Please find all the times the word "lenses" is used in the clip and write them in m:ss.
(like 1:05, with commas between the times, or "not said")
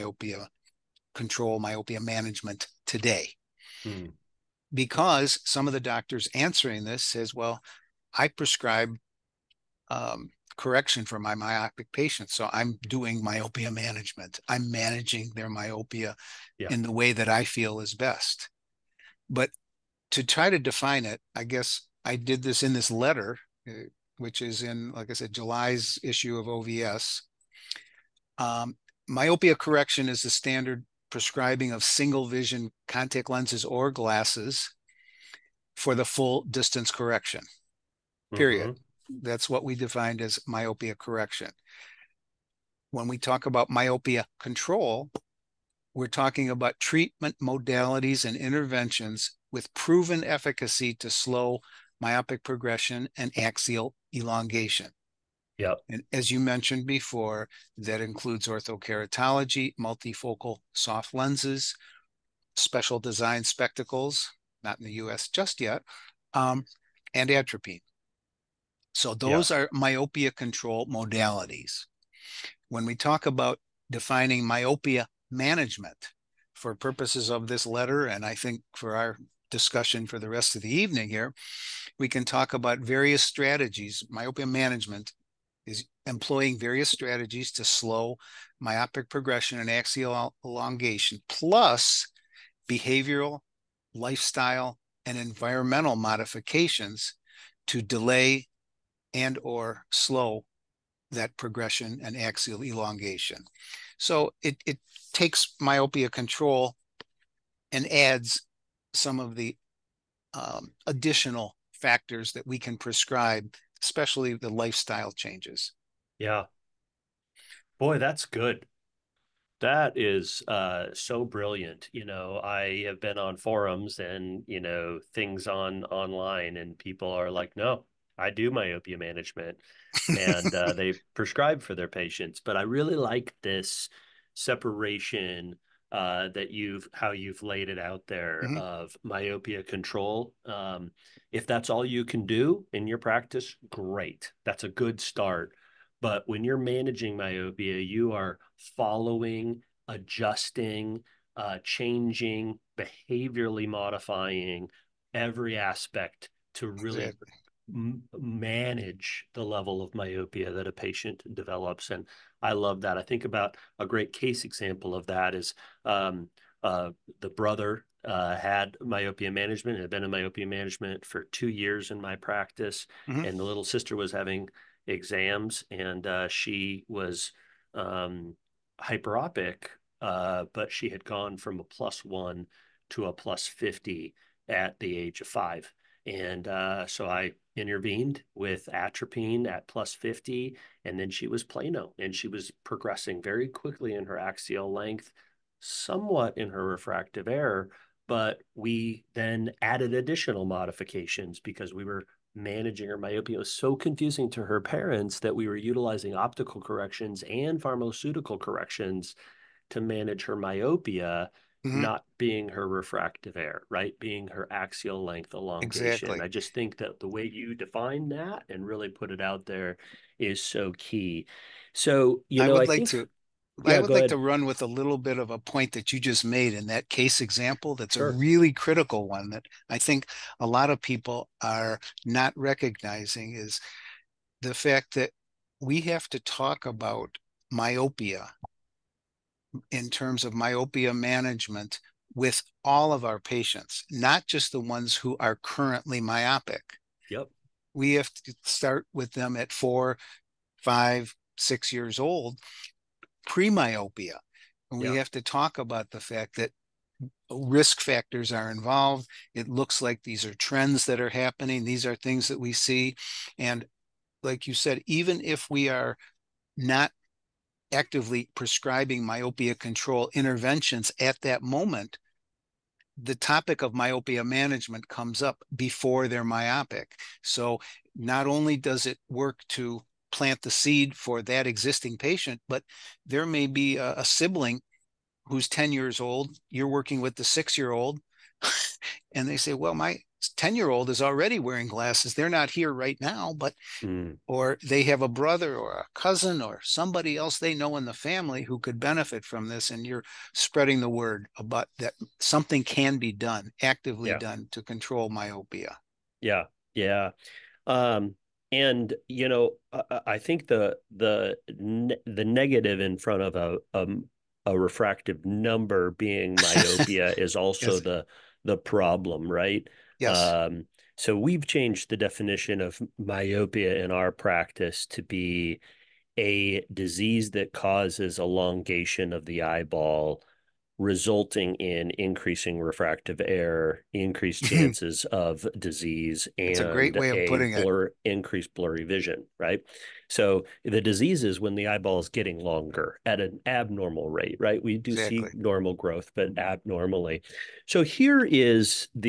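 0:33, 1:01.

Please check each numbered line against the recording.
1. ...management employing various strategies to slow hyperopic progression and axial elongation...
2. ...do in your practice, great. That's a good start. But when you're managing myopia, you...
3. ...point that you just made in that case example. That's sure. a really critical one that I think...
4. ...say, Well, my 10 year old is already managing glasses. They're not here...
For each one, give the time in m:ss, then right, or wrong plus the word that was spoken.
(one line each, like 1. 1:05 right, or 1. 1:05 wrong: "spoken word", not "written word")
1. 1:24 wrong: "myopic", not "hyperopic"
2. 2:22 right
3. 3:45 right
4. 4:49 wrong: "wearing", not "managing".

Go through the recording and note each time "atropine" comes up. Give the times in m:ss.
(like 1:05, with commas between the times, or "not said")
1:07, 3:08.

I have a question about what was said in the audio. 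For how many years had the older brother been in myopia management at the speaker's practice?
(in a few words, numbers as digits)
2.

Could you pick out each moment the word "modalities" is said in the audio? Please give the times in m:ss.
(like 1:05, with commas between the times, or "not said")
0:47, 1:10.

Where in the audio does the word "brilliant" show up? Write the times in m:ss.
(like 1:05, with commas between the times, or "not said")
2:01.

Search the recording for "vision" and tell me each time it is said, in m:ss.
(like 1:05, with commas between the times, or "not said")
0:32, 5:38.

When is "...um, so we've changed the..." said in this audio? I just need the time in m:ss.
5:20.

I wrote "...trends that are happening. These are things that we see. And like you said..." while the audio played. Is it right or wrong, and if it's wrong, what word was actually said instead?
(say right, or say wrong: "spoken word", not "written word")
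right.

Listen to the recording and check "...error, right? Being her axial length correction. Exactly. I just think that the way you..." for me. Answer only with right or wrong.
wrong.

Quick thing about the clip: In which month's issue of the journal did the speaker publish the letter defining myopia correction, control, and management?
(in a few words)
July.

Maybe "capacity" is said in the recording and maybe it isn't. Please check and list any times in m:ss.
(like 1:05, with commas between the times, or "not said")
not said.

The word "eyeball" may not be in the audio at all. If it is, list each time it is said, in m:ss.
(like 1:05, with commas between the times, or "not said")
5:29, 5:41.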